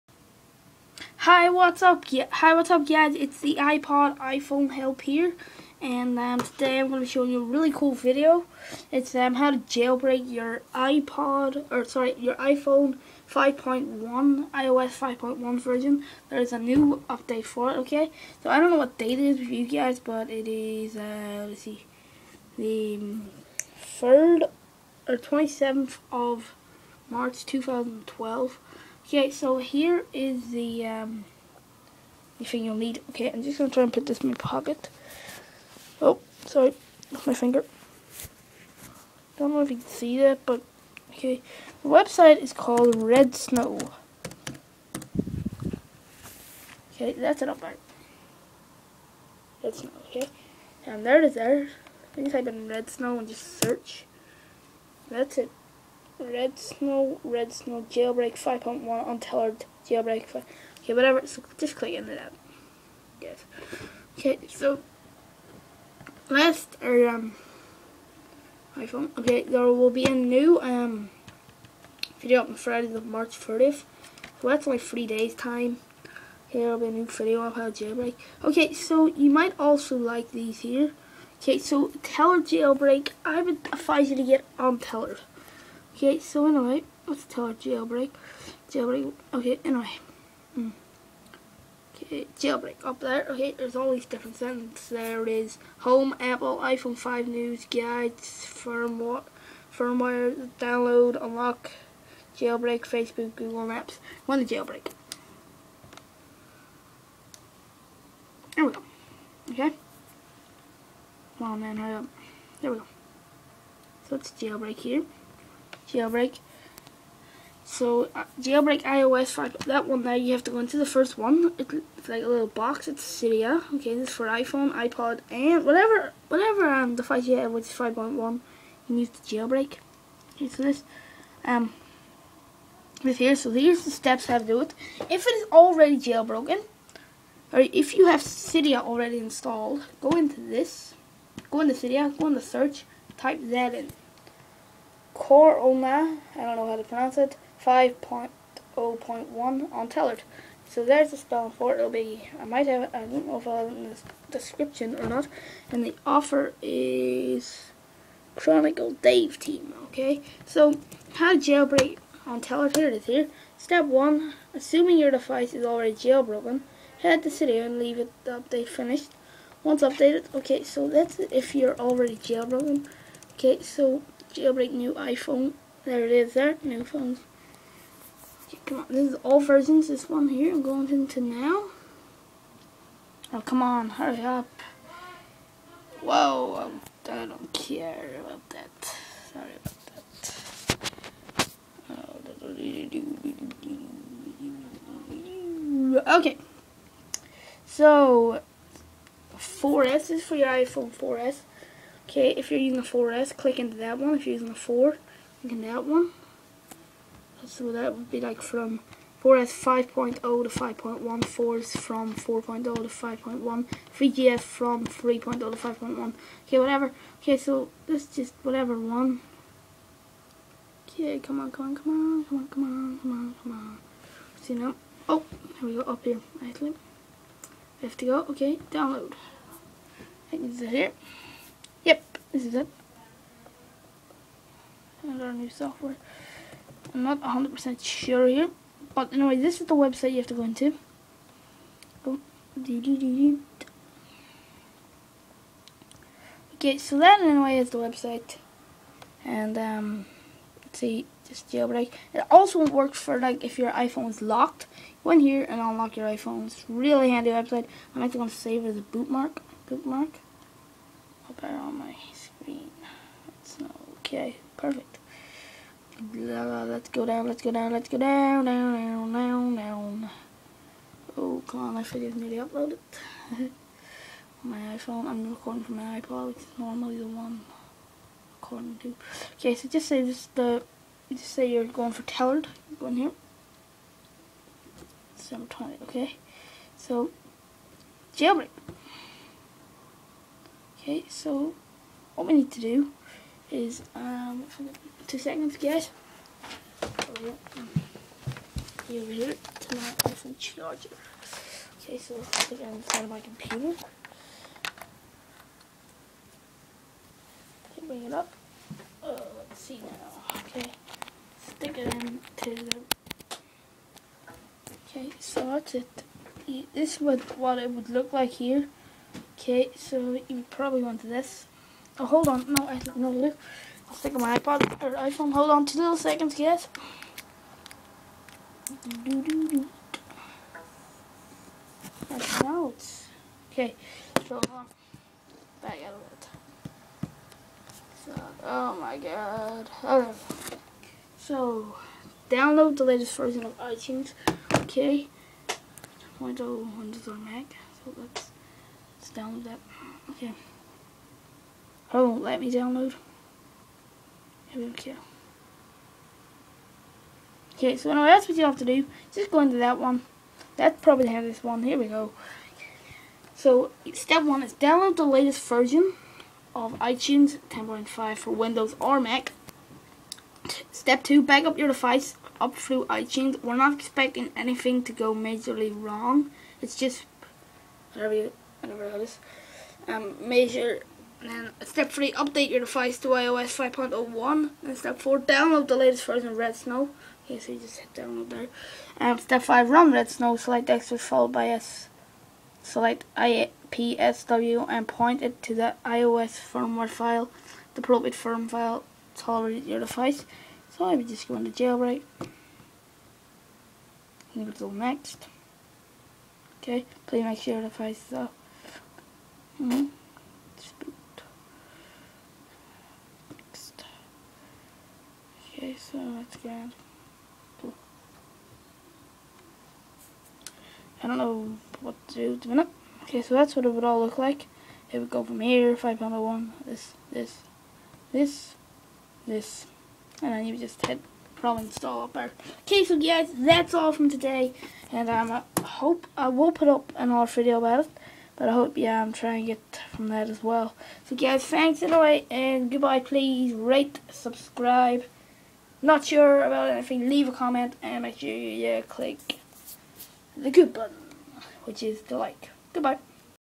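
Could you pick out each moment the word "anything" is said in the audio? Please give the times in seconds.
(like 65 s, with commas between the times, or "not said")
374 s, 446 s.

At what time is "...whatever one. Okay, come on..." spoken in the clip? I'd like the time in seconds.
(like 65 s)
218 s.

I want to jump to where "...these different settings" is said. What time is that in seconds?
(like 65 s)
93 s.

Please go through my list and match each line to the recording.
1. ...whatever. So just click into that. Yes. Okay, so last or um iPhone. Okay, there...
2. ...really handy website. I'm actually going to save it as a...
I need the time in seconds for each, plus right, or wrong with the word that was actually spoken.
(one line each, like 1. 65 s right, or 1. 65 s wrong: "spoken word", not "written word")
1. 60 s right
2. 256 s right.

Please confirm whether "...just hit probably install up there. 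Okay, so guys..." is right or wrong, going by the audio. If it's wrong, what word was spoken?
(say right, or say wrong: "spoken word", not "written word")
right.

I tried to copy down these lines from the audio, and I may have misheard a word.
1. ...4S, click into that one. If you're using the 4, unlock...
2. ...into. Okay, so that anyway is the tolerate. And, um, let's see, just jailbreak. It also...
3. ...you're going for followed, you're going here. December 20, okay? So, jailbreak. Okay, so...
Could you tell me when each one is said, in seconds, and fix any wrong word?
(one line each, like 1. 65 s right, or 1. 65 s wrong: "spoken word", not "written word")
1. 202 s wrong: "click", not "unlock"
2. 240 s wrong: "website", not "tolerate"
3. 281 s wrong: "tailored", not "followed".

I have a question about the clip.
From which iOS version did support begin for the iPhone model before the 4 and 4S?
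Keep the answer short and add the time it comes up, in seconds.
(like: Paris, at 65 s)
3.0, at 213 s.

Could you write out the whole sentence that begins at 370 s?
Step two, back up your device up through iTunes.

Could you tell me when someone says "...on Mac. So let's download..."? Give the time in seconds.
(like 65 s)
347 s.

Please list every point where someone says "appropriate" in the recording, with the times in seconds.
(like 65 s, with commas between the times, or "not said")
397 s.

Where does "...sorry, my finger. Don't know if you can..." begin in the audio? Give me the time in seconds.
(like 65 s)
36 s.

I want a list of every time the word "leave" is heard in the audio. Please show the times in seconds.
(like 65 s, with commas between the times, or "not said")
167 s, 447 s.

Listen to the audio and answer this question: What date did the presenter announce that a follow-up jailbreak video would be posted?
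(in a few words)
Friday, March 30th.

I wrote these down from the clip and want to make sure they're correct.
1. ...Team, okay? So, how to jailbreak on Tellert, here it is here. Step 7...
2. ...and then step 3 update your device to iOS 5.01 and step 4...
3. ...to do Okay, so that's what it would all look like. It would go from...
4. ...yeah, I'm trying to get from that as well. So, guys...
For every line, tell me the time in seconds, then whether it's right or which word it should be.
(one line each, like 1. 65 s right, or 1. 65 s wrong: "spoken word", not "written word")
1. 159 s wrong: "1", not "7"
2. 381 s right
3. 422 s right
4. 438 s right.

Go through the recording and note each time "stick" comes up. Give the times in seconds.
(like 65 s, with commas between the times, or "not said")
311 s, 323 s.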